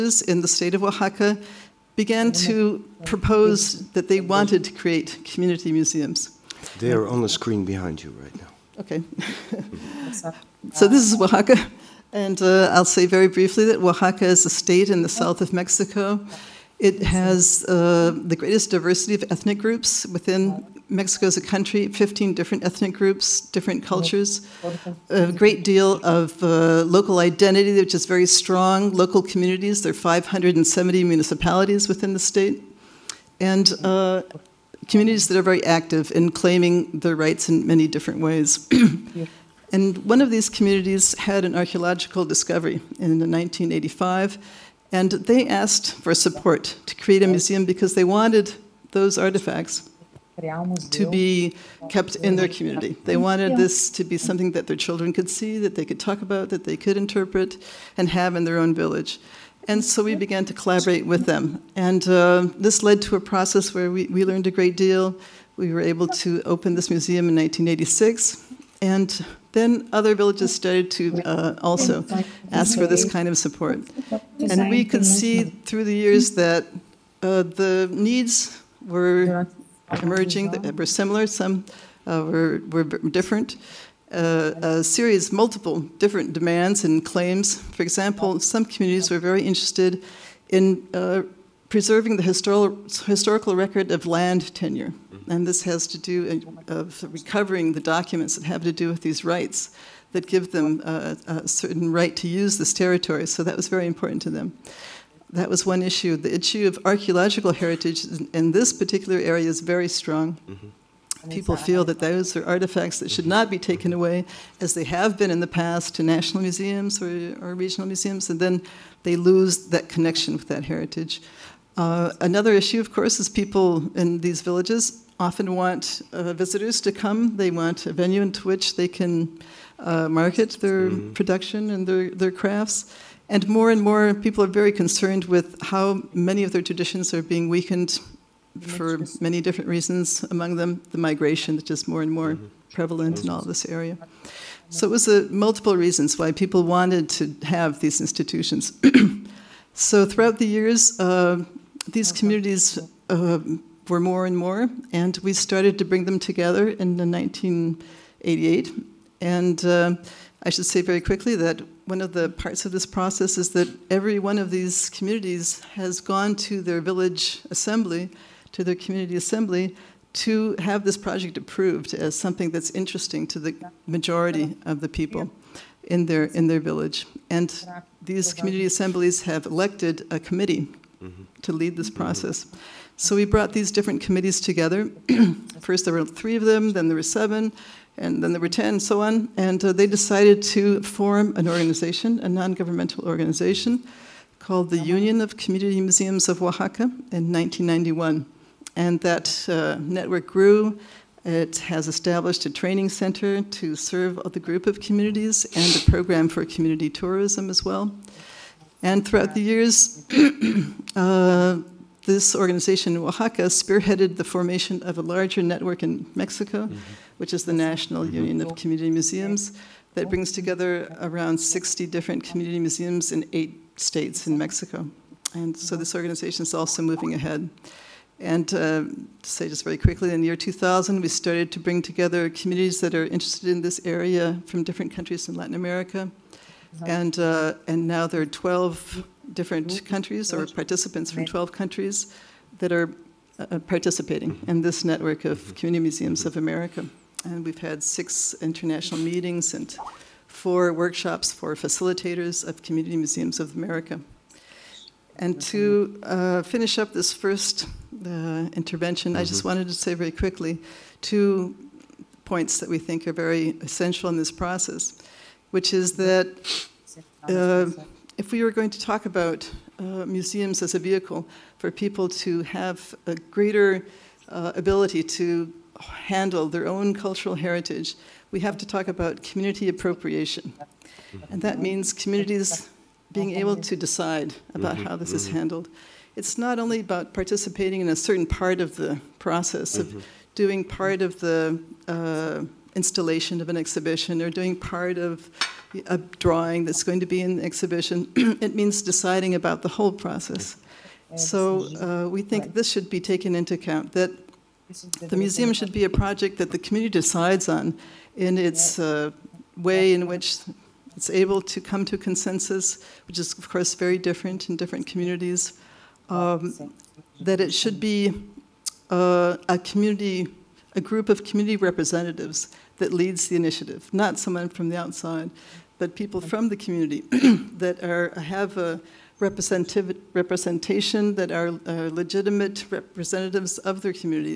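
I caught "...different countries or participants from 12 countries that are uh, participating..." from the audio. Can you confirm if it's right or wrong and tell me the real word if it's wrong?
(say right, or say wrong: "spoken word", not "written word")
right.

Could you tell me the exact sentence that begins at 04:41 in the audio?
And that means communities being able to decide about how this is mm-hmm.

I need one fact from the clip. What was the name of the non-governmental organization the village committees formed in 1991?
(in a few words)
Union of Community Museums of Oaxaca.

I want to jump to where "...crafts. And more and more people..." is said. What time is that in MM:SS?
02:12.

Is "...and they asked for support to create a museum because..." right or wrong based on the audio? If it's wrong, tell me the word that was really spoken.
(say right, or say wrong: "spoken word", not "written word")
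right.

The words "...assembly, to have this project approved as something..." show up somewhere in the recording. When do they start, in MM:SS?
02:49.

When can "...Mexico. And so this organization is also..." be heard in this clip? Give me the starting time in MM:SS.
03:44.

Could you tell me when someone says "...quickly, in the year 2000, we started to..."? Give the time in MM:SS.
03:49.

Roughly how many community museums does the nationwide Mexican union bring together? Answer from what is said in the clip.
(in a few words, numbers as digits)
60.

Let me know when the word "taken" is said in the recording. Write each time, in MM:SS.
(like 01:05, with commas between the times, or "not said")
01:53, 05:02.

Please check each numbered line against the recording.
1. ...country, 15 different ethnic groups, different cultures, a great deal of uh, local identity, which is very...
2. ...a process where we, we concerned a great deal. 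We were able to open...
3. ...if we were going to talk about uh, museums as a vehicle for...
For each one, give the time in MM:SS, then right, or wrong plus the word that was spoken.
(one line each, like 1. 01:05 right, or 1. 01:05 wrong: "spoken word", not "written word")
1. 00:21 right
2. 01:03 wrong: "learned", not "concerned"
3. 04:28 right.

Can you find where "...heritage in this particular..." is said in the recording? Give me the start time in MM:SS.
01:47.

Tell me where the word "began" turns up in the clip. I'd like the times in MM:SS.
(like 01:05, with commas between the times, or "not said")
00:01, 01:00.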